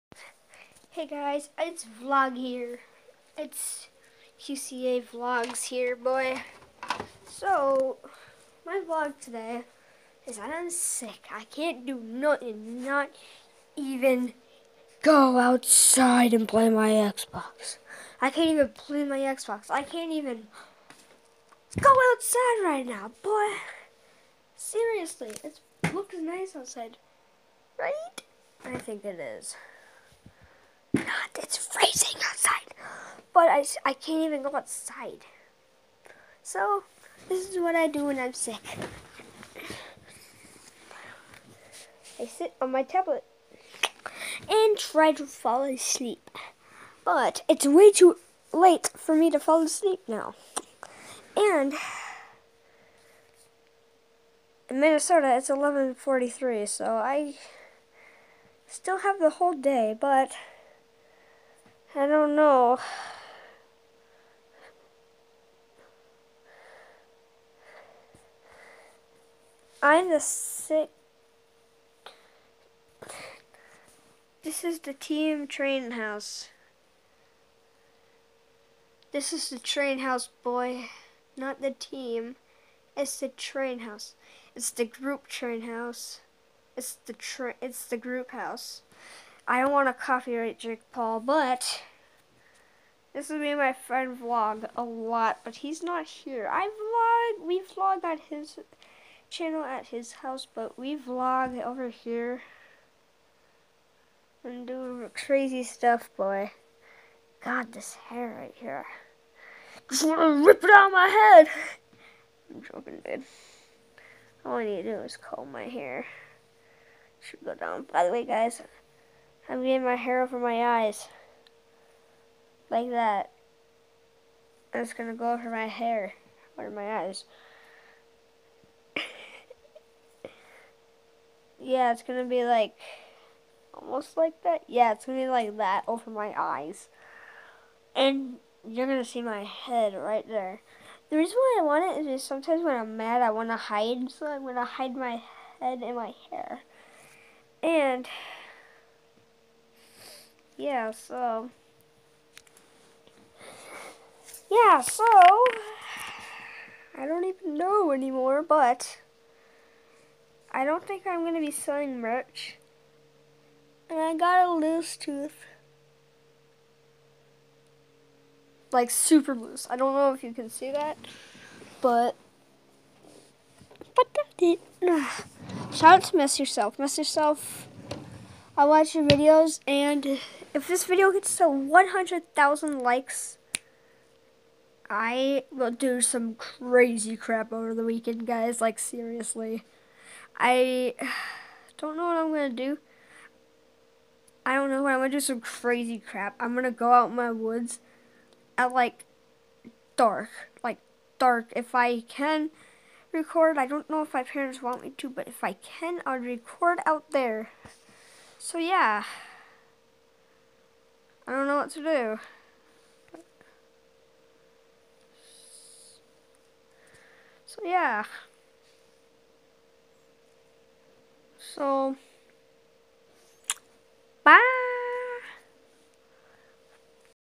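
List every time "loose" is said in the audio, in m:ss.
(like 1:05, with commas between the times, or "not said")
2:44, 2:49.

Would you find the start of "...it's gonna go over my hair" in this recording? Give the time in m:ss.
2:04.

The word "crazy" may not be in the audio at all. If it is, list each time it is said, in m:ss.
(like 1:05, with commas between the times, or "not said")
1:45, 3:06, 3:15.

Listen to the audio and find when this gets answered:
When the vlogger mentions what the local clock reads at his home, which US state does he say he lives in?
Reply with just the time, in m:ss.
0:54.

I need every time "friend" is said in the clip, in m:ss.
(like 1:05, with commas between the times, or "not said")
1:33.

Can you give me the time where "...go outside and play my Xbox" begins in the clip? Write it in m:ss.
0:15.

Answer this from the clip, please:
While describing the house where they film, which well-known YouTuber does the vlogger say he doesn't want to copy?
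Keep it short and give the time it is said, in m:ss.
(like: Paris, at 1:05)
Jake Paul, at 1:30.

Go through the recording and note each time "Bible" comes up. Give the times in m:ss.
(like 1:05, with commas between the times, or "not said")
not said.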